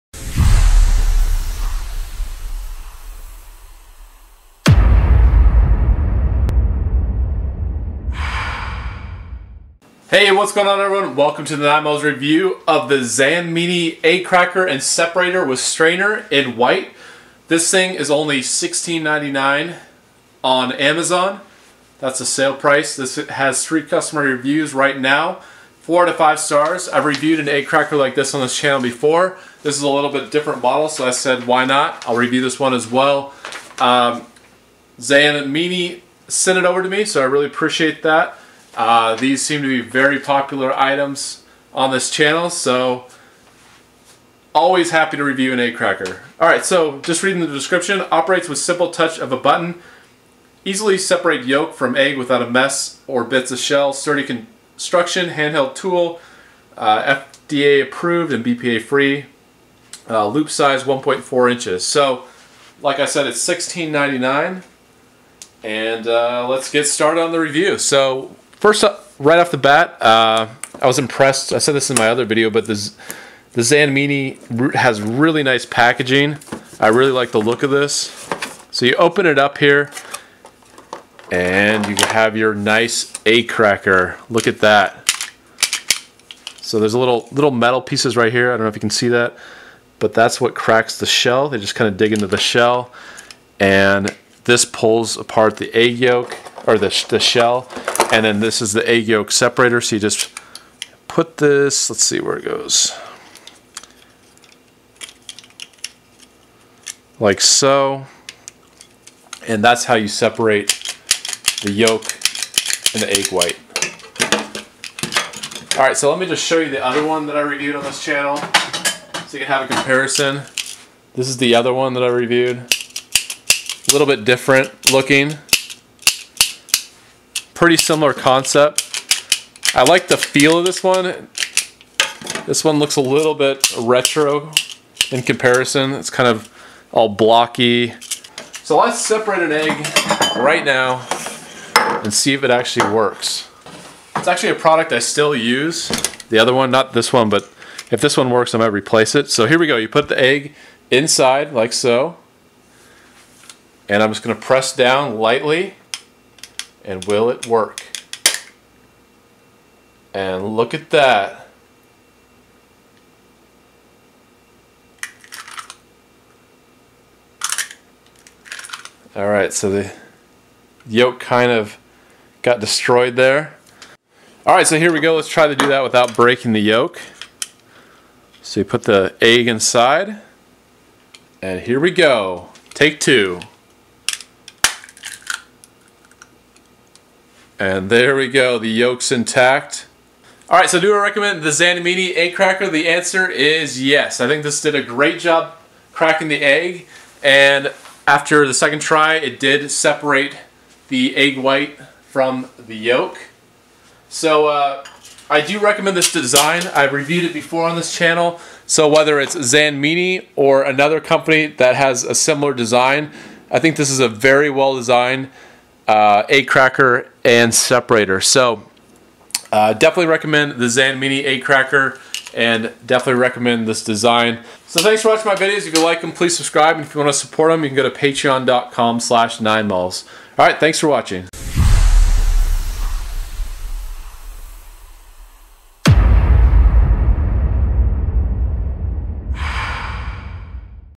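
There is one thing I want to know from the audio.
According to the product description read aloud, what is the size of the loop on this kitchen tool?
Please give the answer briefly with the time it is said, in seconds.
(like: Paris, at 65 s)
1.4 inches, at 60 s.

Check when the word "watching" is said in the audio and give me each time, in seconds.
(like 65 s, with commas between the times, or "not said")
225 s, 230 s.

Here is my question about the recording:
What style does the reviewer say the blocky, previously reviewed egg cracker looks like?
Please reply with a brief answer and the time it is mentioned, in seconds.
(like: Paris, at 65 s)
retro, at 133 s.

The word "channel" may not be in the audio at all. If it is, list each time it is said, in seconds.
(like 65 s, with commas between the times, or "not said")
28 s, 42 s, 118 s, 207 s.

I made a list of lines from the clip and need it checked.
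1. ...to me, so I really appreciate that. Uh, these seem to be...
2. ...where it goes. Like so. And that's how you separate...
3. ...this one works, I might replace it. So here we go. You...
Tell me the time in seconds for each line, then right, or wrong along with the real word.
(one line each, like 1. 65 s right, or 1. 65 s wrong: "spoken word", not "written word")
1. 36 s right
2. 102 s right
3. 148 s right.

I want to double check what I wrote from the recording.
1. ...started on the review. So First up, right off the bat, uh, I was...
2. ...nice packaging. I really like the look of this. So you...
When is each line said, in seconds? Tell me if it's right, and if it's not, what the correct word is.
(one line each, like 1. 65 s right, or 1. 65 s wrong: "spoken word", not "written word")
1. 66 s right
2. 75 s right.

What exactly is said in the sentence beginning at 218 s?
So uh, definitely recommend the Zanmini eight cracker and definitely recommend this design.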